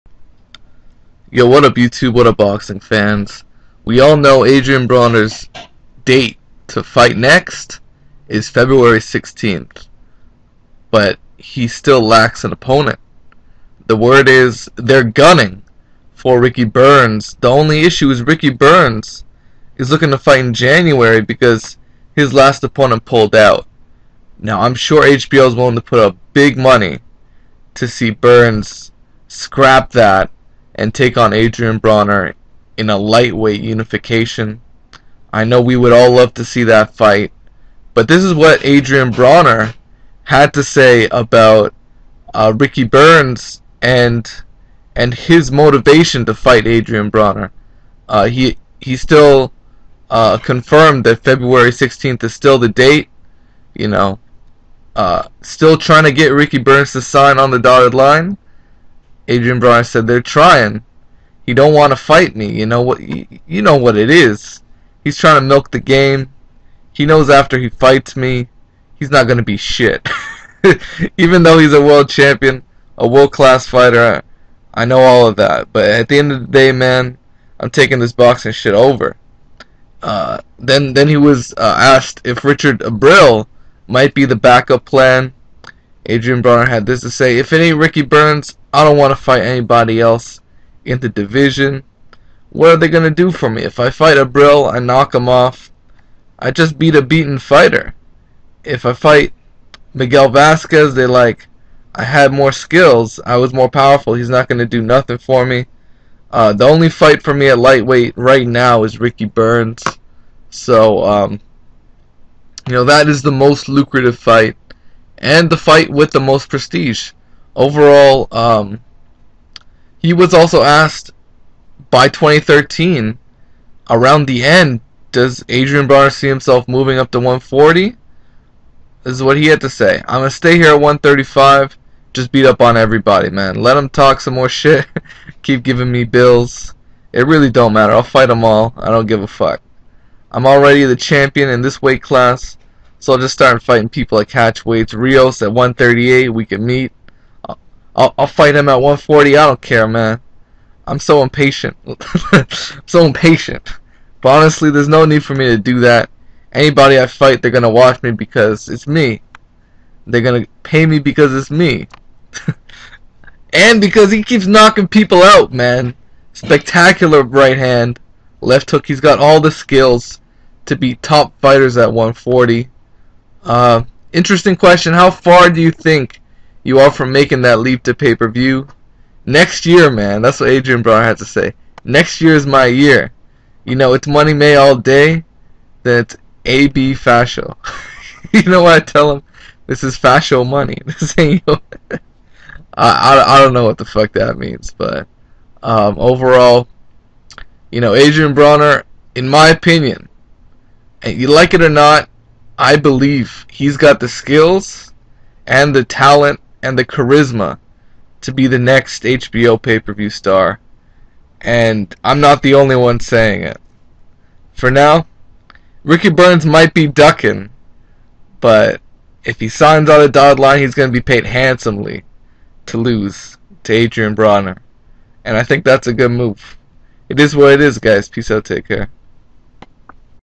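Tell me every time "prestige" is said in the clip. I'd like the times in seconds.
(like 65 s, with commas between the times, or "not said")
116 s.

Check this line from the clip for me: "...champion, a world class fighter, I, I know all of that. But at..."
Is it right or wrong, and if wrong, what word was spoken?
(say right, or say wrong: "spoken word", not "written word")
right.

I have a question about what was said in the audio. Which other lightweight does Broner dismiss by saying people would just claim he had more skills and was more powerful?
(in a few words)
Miguel Vasquez.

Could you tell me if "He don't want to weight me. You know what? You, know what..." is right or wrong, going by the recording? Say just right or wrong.
wrong.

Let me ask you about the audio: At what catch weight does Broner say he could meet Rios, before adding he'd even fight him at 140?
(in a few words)
138.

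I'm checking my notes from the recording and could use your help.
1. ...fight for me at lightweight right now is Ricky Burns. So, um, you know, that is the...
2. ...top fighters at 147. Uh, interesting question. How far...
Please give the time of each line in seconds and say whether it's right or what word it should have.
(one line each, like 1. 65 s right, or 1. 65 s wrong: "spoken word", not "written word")
1. 106 s right
2. 170 s wrong: "140", not "147".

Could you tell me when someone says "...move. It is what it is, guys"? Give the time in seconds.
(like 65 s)
226 s.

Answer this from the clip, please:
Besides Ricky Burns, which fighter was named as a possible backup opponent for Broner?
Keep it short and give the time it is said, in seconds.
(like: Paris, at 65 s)
Richard Abril, at 82 s.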